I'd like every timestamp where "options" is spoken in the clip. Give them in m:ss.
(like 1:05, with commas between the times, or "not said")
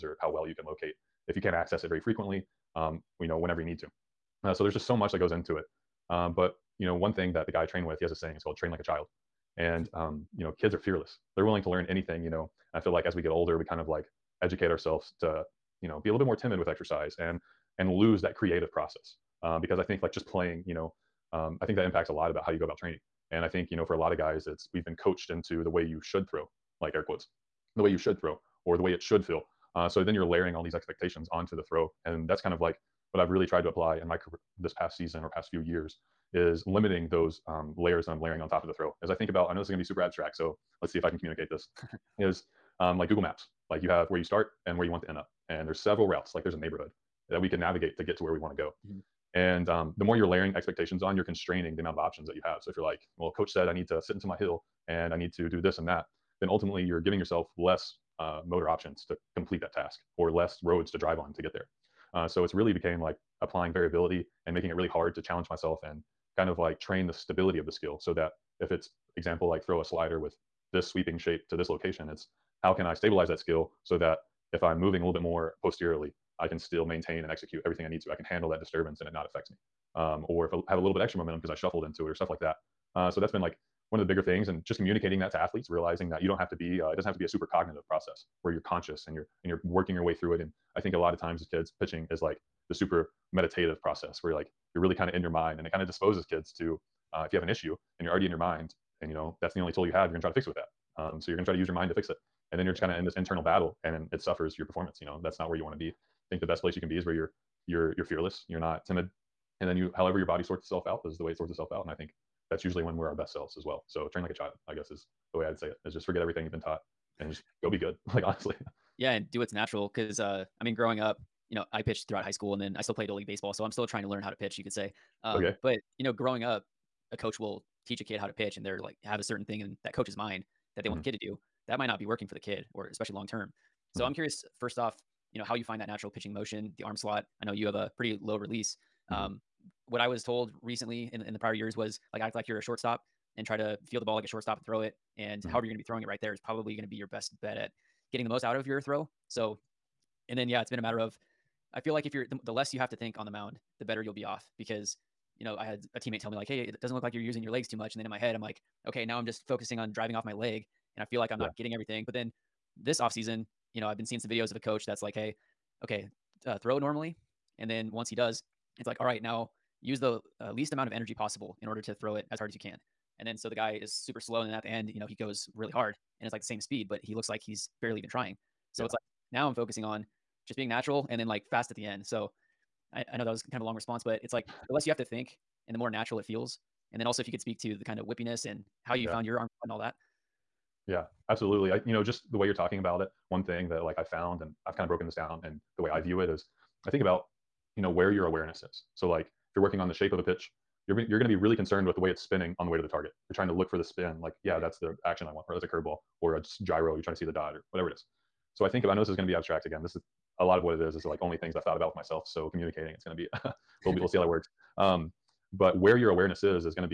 0:51, 0:58.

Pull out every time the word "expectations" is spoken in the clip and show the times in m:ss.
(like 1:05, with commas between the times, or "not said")
0:30, 0:50.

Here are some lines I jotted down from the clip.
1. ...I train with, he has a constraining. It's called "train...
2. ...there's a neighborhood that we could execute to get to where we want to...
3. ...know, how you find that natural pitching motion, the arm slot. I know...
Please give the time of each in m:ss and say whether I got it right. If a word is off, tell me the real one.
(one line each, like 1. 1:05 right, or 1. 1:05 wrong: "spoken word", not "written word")
1. 0:07 wrong: "saying", not "constraining"
2. 0:46 wrong: "navigate", not "execute"
3. 2:15 right.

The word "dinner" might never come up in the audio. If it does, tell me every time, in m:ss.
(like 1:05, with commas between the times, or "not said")
not said.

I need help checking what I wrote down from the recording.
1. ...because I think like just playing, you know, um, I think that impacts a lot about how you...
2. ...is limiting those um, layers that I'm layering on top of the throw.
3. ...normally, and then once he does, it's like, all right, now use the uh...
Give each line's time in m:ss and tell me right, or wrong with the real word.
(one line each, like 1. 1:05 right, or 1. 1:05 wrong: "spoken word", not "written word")
1. 0:19 right
2. 0:36 right
3. 2:46 right.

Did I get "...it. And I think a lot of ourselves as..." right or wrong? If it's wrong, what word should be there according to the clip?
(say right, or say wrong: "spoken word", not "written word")
wrong: "times", not "ourselves".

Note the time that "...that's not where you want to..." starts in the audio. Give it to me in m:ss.
1:45.